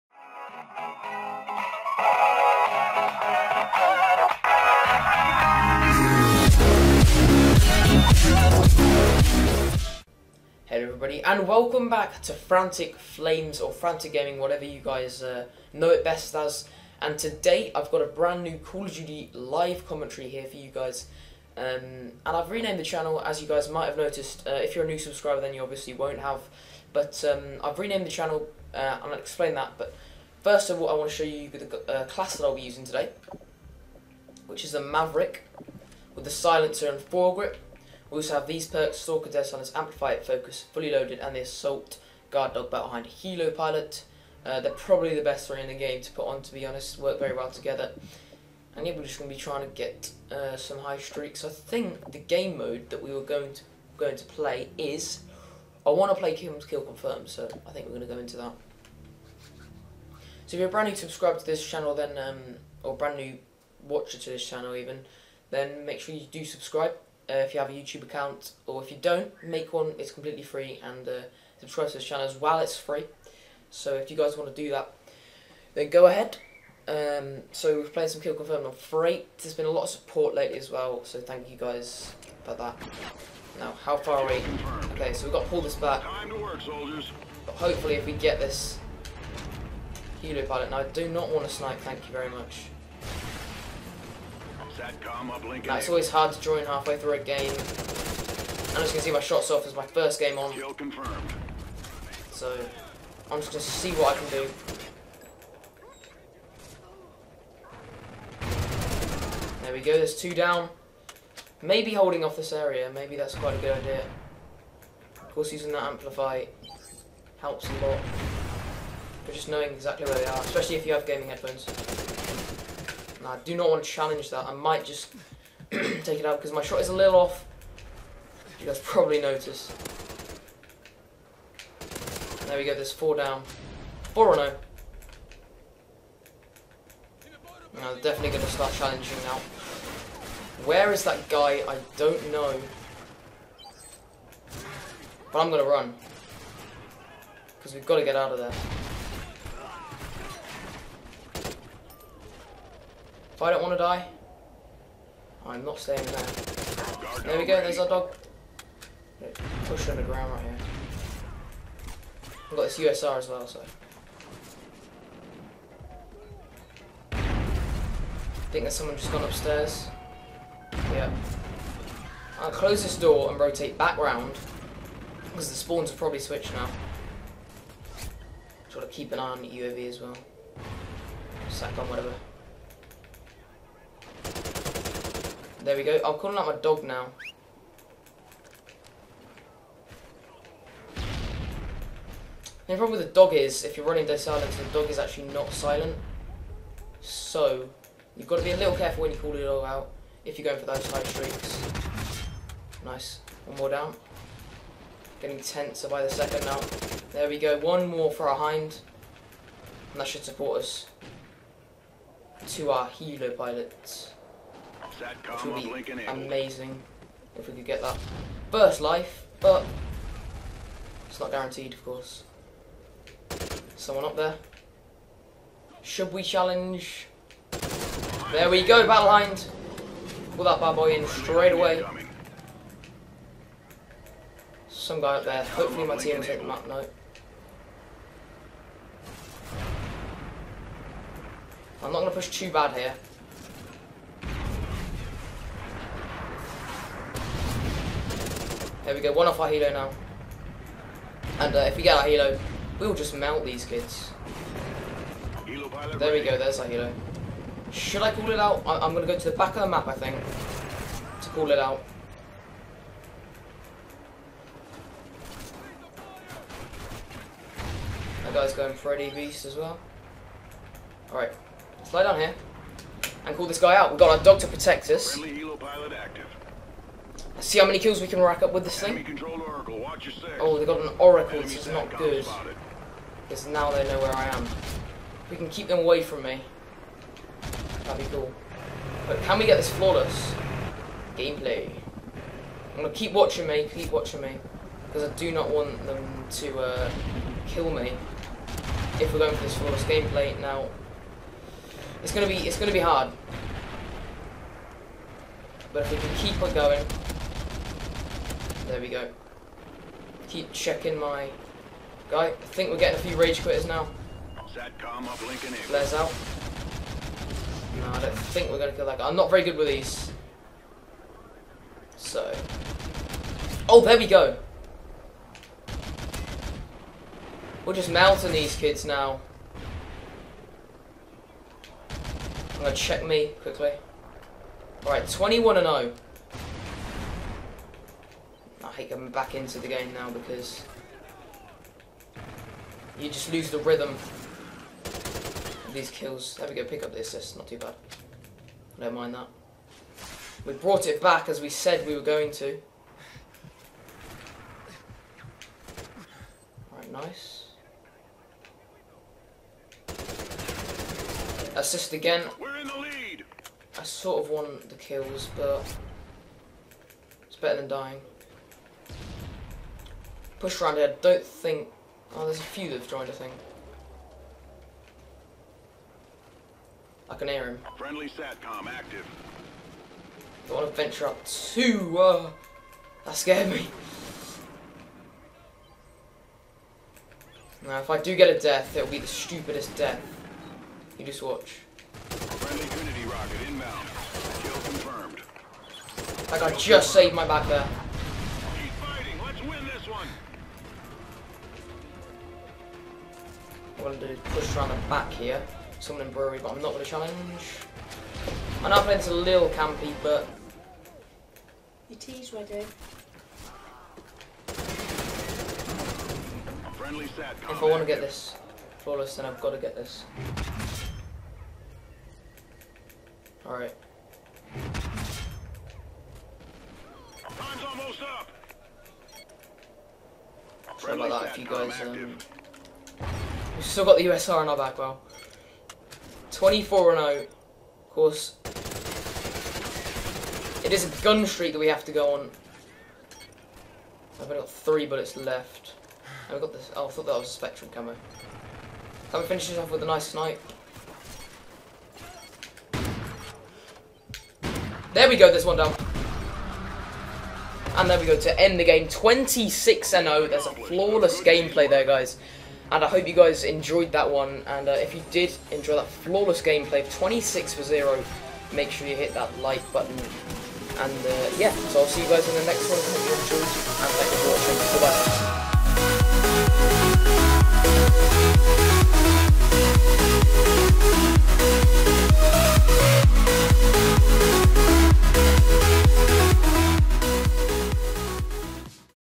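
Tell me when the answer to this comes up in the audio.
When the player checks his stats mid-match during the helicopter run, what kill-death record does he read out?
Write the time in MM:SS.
05:35.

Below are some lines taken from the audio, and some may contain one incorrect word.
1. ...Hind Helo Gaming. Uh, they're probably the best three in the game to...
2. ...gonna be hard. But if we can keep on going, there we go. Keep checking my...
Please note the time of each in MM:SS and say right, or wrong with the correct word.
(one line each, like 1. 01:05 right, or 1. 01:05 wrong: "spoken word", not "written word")
1. 00:42 wrong: "Pilot", not "Gaming"
2. 05:02 right.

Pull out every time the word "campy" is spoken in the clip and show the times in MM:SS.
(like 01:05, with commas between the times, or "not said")
06:49.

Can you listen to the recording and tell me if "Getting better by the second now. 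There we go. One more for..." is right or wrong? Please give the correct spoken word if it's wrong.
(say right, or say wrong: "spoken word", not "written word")
wrong: "tenser", not "better".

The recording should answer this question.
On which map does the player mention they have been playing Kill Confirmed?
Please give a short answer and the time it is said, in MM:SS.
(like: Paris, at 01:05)
Freight, at 01:18.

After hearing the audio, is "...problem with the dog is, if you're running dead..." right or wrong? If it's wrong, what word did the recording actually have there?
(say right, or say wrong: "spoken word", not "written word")
right.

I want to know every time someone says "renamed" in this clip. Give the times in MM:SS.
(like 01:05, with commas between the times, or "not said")
00:22, 00:27.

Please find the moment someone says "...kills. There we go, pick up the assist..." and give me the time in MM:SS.
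05:45.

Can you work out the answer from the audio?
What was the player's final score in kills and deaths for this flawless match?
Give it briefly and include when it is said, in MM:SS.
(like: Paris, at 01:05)
26-0, at 07:38.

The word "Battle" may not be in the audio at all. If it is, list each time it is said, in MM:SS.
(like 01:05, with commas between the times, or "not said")
00:42, 03:48.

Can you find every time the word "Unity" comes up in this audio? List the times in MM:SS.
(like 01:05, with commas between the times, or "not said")
06:32.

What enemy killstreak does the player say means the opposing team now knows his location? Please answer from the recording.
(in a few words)
oracle.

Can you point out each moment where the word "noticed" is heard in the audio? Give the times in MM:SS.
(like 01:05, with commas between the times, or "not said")
00:23, 02:09.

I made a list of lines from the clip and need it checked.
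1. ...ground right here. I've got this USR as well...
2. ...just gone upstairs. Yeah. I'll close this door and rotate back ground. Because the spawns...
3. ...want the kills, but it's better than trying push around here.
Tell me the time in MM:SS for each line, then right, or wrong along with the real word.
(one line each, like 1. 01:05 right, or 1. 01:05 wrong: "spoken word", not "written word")
1. 02:40 right
2. 02:48 wrong: "round", not "ground"
3. 06:04 wrong: "dying", not "trying".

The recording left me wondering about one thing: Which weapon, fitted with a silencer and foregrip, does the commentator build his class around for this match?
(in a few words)
Maverick.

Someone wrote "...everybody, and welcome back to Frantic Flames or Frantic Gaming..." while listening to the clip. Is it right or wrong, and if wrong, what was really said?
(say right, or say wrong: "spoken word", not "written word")
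right.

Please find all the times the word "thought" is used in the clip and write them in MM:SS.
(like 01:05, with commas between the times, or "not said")
07:26.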